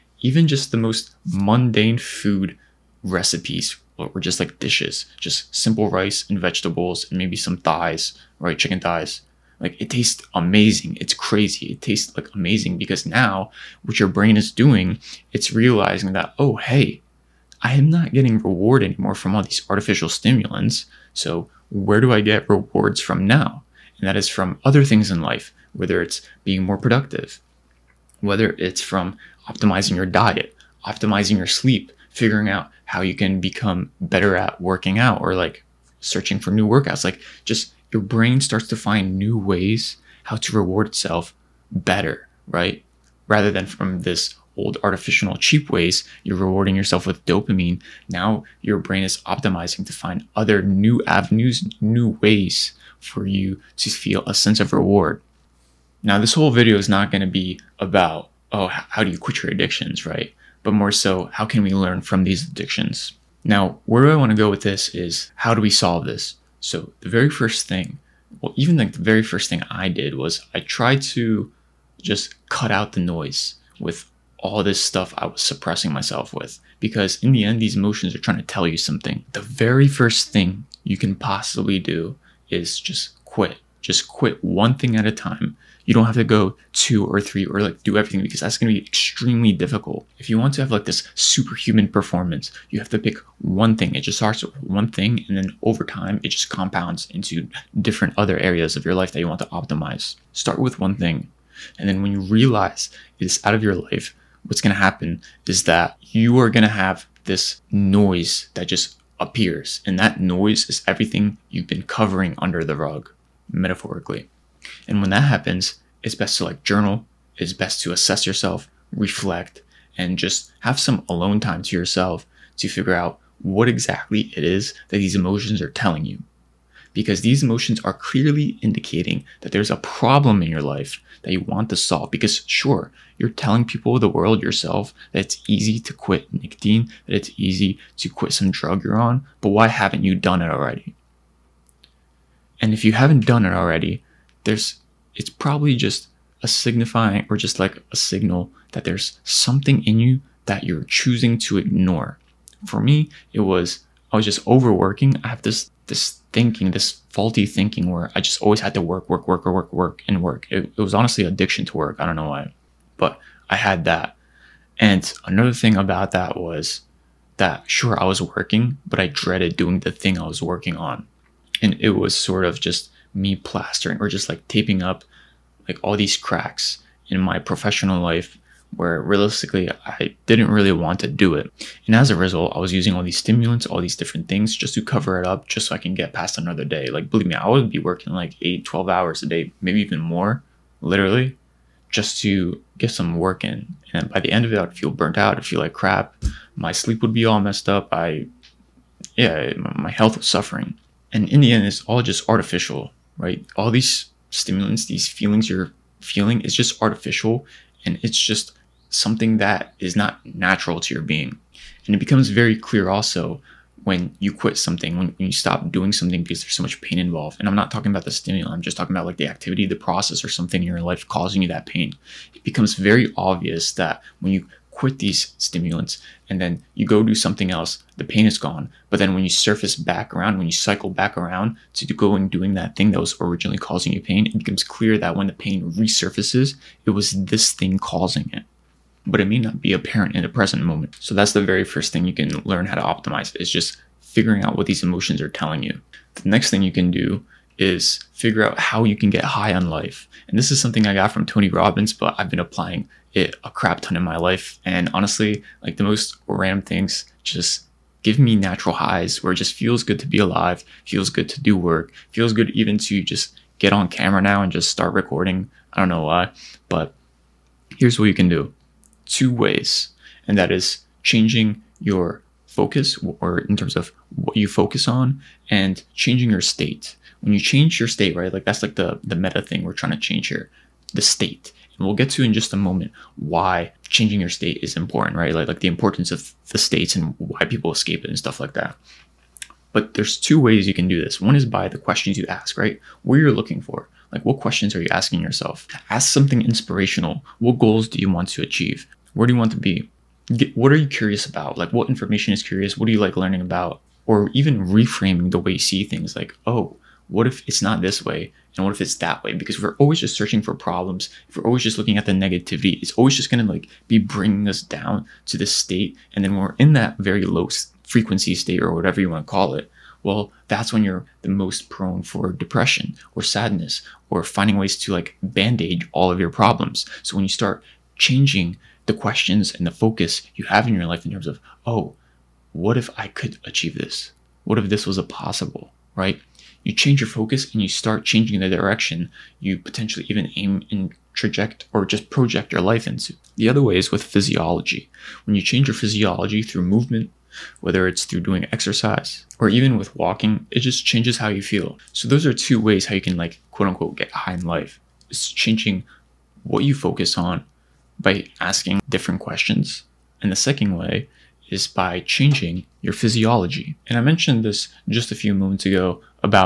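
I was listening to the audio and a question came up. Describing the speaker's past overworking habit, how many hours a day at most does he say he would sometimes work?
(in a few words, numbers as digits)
12.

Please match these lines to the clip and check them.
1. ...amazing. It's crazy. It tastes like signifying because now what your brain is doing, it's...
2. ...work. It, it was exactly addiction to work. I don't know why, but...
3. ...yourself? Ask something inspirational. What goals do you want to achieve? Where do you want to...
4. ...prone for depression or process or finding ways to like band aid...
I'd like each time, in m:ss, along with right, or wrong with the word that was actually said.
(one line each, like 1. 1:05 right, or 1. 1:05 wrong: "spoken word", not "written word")
1. 0:10 wrong: "amazing", not "signifying"
2. 2:40 wrong: "honestly", not "exactly"
3. 4:55 right
4. 5:21 wrong: "sadness", not "process".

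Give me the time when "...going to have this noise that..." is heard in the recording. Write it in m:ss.
1:46.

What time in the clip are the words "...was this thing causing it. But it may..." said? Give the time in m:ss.
3:56.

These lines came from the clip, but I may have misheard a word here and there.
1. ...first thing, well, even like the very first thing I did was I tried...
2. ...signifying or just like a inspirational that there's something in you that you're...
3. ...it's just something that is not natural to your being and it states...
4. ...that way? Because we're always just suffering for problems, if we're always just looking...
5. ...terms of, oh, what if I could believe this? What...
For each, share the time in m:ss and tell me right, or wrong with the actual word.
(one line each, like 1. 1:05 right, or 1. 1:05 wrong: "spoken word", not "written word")
1. 1:07 right
2. 2:26 wrong: "signal", not "inspirational"
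3. 3:28 wrong: "becomes", not "states"
4. 5:08 wrong: "searching", not "suffering"
5. 5:31 wrong: "achieve", not "believe".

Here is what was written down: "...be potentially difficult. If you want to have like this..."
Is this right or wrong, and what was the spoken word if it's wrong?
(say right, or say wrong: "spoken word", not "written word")
wrong: "extremely", not "potentially".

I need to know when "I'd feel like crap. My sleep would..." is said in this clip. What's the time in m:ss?
3:15.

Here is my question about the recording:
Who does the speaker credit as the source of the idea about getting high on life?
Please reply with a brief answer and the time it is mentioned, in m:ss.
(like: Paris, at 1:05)
Tony Robbins, at 4:11.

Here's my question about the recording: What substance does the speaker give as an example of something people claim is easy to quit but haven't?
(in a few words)
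Nicotine.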